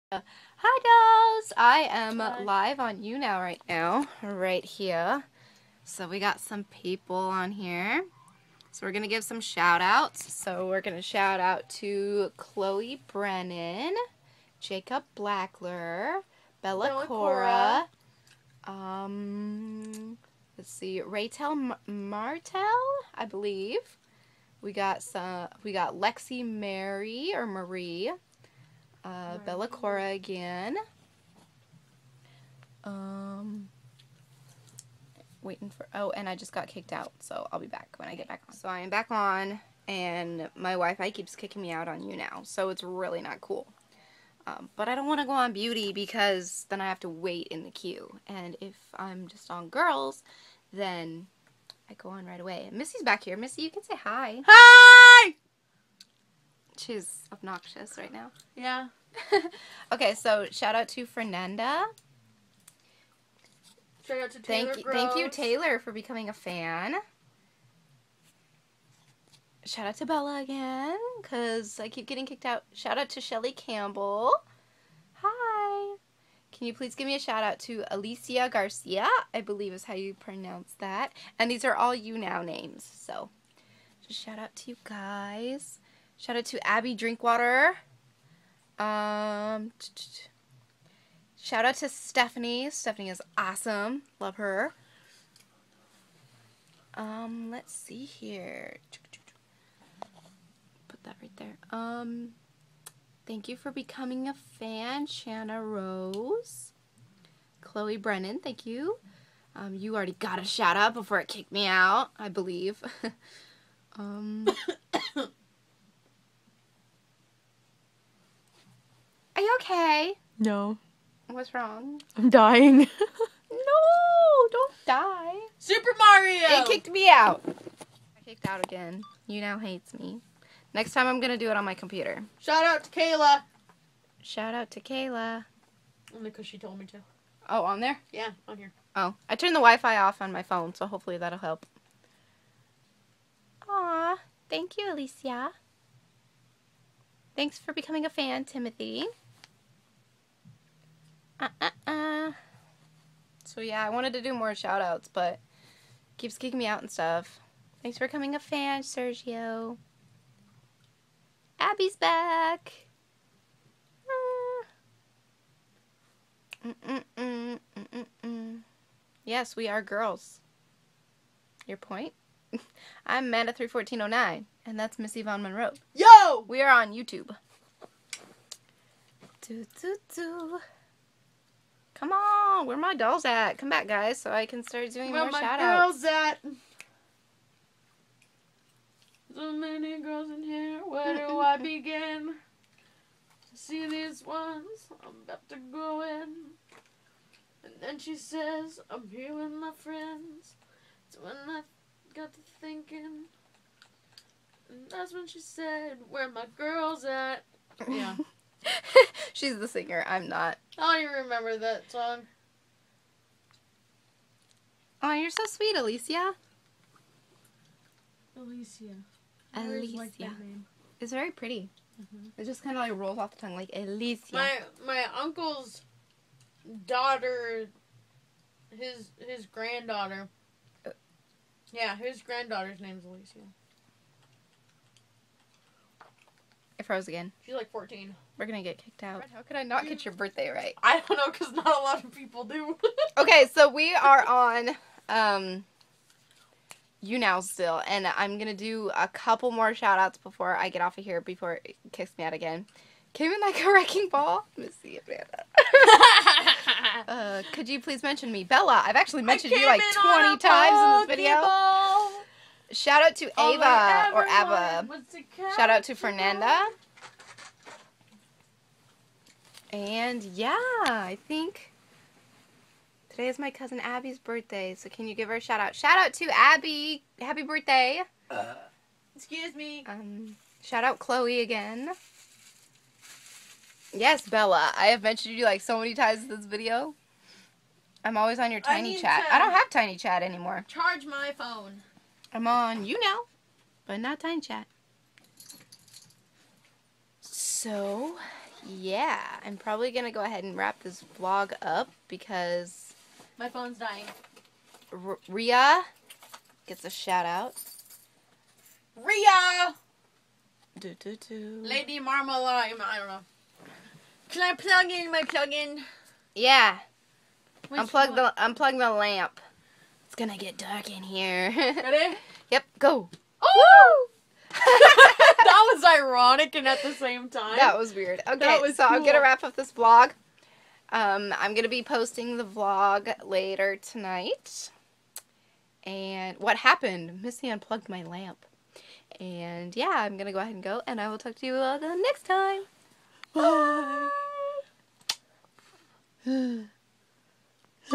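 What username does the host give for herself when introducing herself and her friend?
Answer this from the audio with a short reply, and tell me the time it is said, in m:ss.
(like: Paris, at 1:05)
Manda 31409, at 2:53.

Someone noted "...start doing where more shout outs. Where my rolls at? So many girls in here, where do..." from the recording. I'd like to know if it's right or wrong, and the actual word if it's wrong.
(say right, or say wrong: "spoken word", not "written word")
wrong: "girls", not "rolls".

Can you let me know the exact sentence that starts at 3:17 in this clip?
And then she says, I'm here with my friends.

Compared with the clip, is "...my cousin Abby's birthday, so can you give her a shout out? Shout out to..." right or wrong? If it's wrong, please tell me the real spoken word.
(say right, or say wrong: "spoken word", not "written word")
right.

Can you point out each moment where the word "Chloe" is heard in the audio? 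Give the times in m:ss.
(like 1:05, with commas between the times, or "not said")
0:12, 1:47, 4:40.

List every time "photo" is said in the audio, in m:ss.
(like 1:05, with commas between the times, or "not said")
not said.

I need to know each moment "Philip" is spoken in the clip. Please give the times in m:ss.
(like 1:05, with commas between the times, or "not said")
not said.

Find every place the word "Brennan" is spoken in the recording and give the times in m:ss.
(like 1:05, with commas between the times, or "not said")
0:13, 1:47.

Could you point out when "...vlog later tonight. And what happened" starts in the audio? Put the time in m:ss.
5:32.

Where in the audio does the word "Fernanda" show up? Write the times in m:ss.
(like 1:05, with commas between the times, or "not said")
1:01, 4:25.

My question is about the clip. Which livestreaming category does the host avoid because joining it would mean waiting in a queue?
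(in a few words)
Beauty.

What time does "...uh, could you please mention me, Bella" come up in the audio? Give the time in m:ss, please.
4:17.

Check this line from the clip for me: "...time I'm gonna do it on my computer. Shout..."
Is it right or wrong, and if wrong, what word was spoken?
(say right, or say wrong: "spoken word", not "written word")
right.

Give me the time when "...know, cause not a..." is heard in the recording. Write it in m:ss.
4:01.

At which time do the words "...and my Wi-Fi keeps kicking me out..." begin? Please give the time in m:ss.
0:39.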